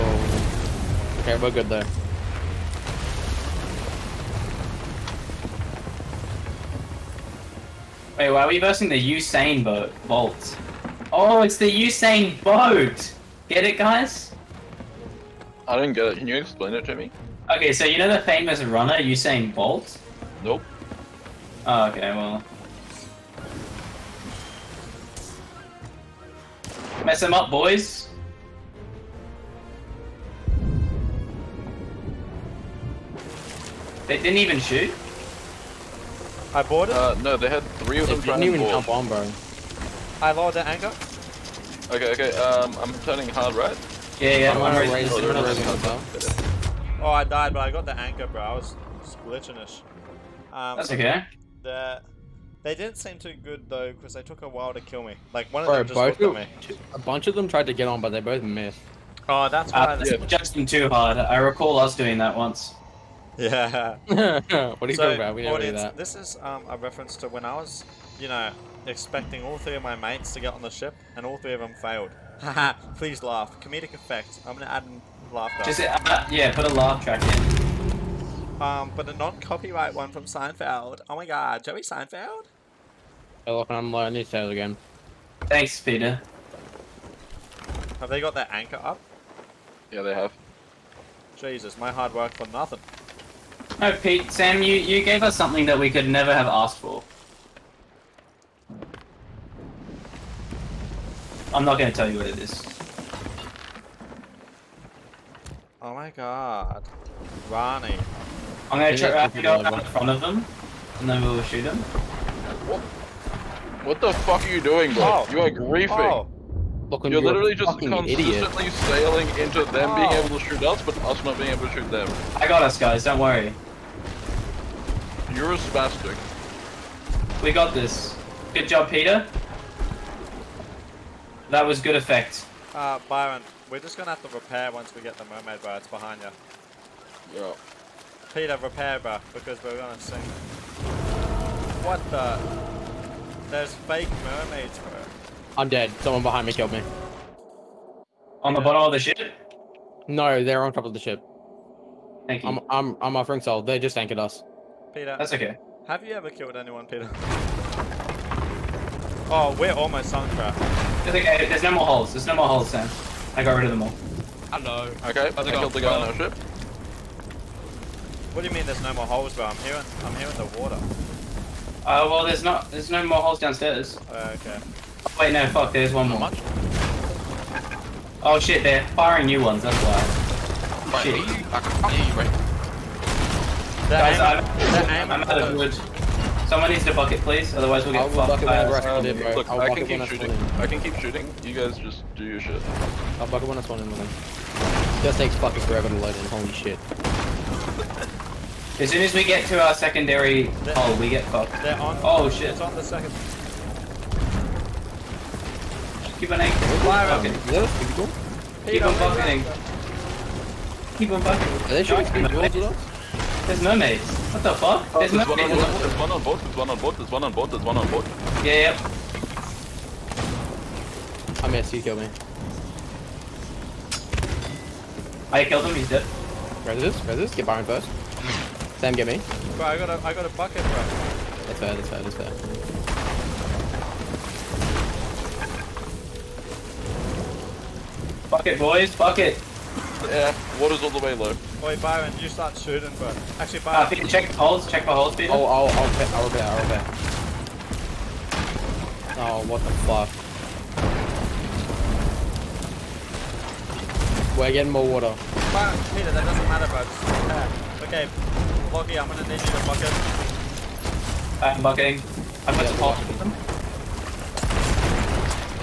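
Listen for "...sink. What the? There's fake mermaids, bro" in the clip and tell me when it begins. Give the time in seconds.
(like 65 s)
139 s.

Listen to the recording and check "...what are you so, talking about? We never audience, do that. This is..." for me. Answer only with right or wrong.
right.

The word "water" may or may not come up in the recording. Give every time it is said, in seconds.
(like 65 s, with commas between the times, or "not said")
170 s, 240 s, 254 s.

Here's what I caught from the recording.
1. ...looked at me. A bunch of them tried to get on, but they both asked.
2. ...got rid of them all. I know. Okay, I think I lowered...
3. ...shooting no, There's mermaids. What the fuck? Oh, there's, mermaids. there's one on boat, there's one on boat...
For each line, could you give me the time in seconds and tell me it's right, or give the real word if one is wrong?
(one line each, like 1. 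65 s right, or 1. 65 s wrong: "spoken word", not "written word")
1. 56 s wrong: "missed", not "asked"
2. 163 s wrong: "killed", not "lowered"
3. 211 s right.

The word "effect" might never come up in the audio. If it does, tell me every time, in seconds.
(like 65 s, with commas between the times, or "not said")
73 s, 131 s.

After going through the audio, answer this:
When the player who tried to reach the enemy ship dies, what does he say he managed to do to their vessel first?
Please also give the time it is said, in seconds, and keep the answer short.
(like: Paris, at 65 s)
lowered the anchor, at 40 s.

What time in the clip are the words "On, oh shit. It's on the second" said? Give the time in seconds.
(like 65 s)
201 s.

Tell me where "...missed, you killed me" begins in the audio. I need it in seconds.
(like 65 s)
221 s.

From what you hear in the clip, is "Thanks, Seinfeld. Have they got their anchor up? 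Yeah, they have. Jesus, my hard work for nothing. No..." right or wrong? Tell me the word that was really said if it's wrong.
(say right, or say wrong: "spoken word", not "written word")
wrong: "Peter", not "Seinfeld".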